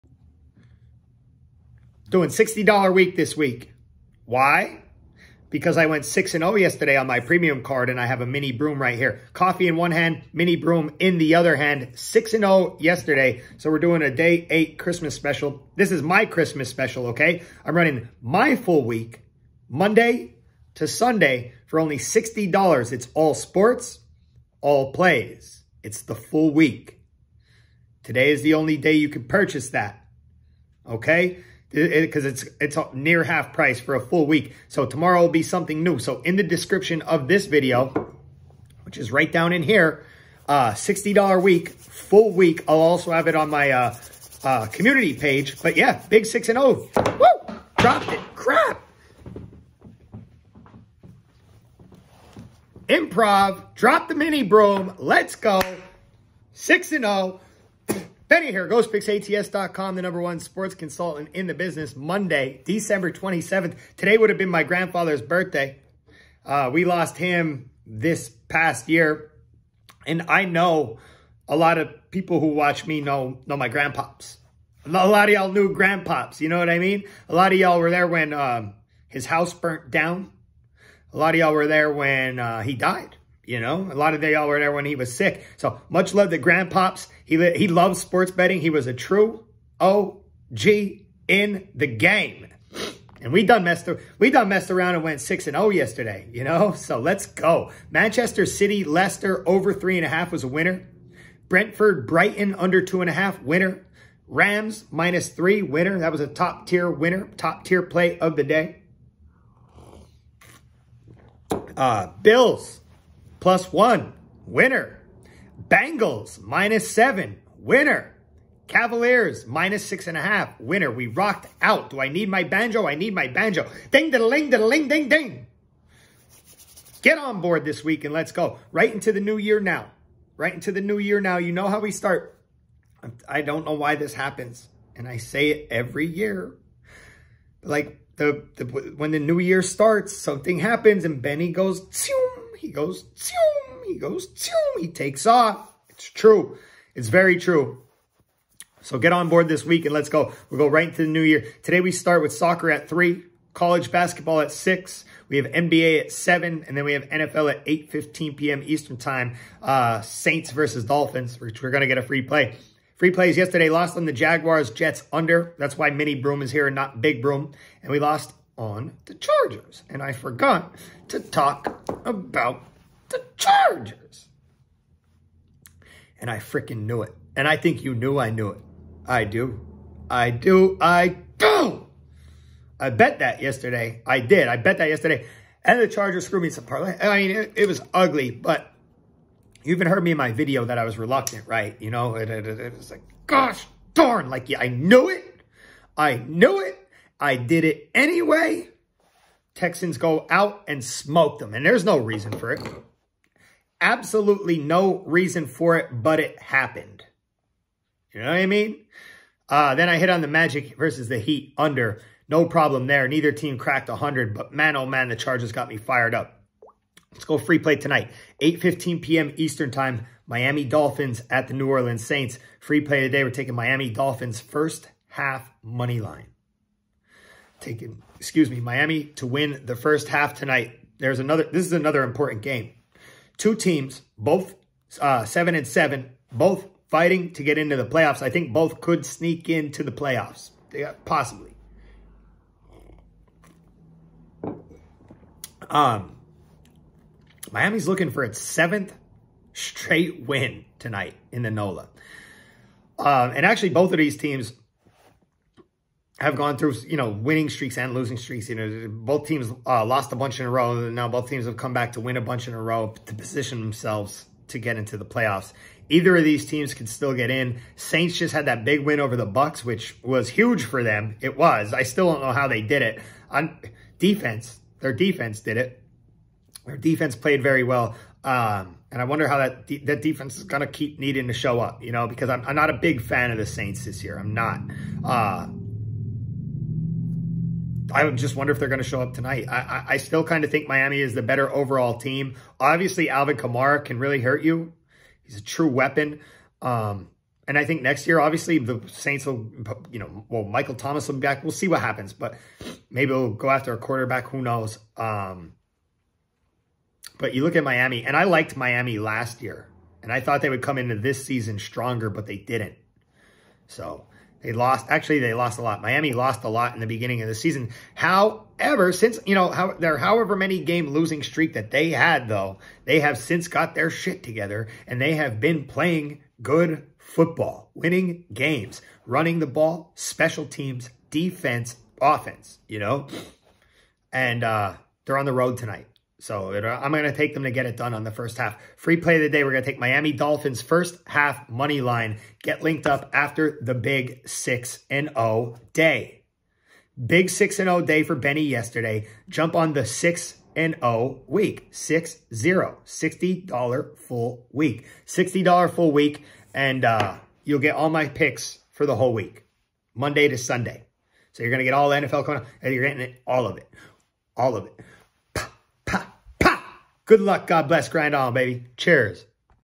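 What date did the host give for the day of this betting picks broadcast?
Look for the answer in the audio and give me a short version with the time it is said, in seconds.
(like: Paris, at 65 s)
Monday, December 27th, at 62 s.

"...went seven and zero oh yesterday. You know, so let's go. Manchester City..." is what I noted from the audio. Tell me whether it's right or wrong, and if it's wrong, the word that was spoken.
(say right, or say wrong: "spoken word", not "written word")
wrong: "six", not "seven".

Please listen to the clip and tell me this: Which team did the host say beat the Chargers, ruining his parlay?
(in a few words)
Texans.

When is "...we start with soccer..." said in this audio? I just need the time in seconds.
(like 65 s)
151 s.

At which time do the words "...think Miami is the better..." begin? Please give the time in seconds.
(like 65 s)
290 s.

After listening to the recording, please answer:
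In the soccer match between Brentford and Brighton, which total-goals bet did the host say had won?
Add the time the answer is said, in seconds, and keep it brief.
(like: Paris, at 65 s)
Under 2.5, at 102 s.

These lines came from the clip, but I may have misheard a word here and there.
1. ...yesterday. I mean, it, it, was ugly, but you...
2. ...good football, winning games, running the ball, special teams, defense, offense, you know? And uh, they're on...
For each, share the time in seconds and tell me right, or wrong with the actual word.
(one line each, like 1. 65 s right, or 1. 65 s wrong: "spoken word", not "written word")
1. 186 s wrong: "parlay", not "yesterday"
2. 326 s right.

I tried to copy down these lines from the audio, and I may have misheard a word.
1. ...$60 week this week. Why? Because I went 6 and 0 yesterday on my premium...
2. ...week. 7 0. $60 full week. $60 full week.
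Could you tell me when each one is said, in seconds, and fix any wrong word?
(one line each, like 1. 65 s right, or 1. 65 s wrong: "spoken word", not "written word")
1. 2 s right
2. 351 s wrong: "6", not "7".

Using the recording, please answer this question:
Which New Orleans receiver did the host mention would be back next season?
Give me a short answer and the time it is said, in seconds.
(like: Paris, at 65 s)
Michael Thomas, at 300 s.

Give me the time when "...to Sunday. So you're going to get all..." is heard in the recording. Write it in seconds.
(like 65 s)
360 s.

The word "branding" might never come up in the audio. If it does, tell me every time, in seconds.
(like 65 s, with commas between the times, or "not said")
not said.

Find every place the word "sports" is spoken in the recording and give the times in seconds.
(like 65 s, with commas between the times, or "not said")
23 s, 60 s, 87 s.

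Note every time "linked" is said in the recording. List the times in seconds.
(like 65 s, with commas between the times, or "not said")
342 s.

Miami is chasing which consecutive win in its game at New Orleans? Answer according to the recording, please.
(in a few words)
7th straight win.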